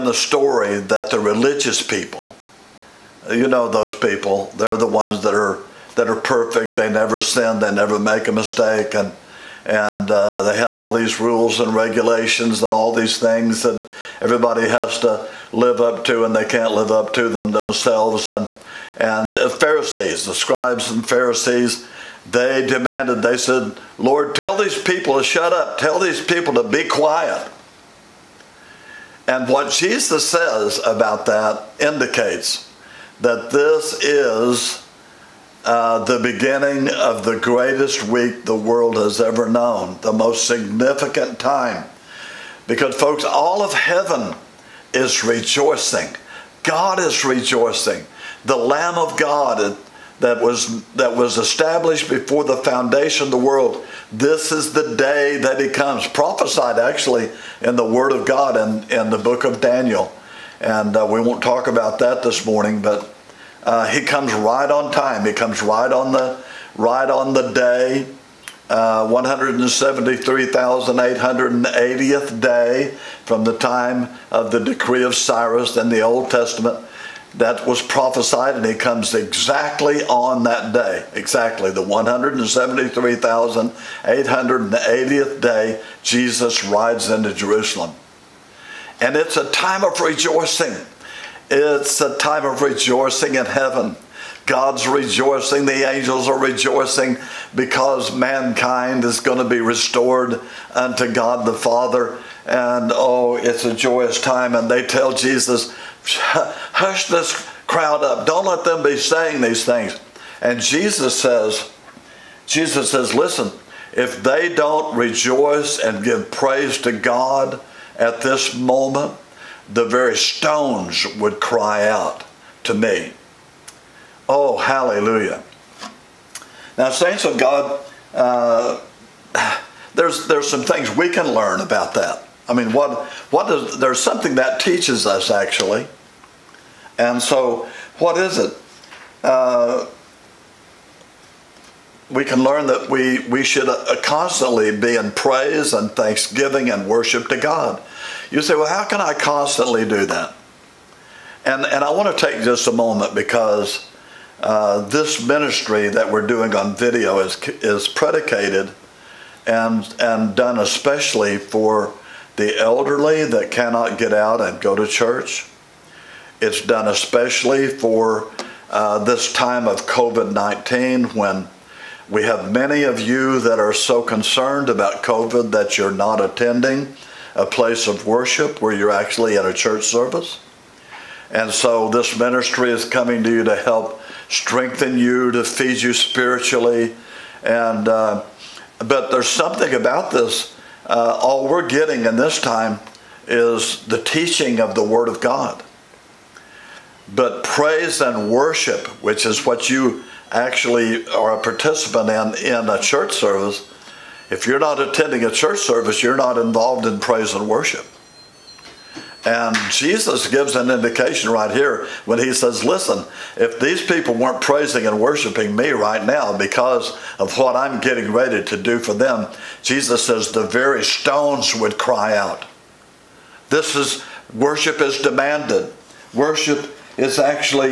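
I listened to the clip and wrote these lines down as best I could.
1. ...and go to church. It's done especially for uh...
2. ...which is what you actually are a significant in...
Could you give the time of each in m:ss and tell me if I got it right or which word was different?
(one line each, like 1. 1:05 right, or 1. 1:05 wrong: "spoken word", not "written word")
1. 2:44 right
2. 3:19 wrong: "participant", not "significant".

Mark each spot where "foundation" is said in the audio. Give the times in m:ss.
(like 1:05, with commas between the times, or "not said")
0:52.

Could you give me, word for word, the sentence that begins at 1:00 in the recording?
And uh, we won't talk about that this morning, but uh, he comes right on time.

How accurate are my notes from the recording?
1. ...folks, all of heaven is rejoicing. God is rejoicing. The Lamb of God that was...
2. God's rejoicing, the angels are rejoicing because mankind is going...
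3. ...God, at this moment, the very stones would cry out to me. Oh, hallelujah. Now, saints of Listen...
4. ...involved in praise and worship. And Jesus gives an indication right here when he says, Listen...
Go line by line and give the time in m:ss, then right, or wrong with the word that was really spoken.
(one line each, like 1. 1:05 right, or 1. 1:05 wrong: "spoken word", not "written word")
1. 0:42 right
2. 1:34 right
3. 1:56 wrong: "God", not "Listen"
4. 3:26 right.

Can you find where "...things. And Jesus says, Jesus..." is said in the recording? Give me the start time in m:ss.
1:49.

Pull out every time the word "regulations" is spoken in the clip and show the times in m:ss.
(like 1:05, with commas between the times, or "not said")
0:11.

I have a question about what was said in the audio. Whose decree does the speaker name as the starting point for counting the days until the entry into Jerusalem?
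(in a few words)
Cyrus.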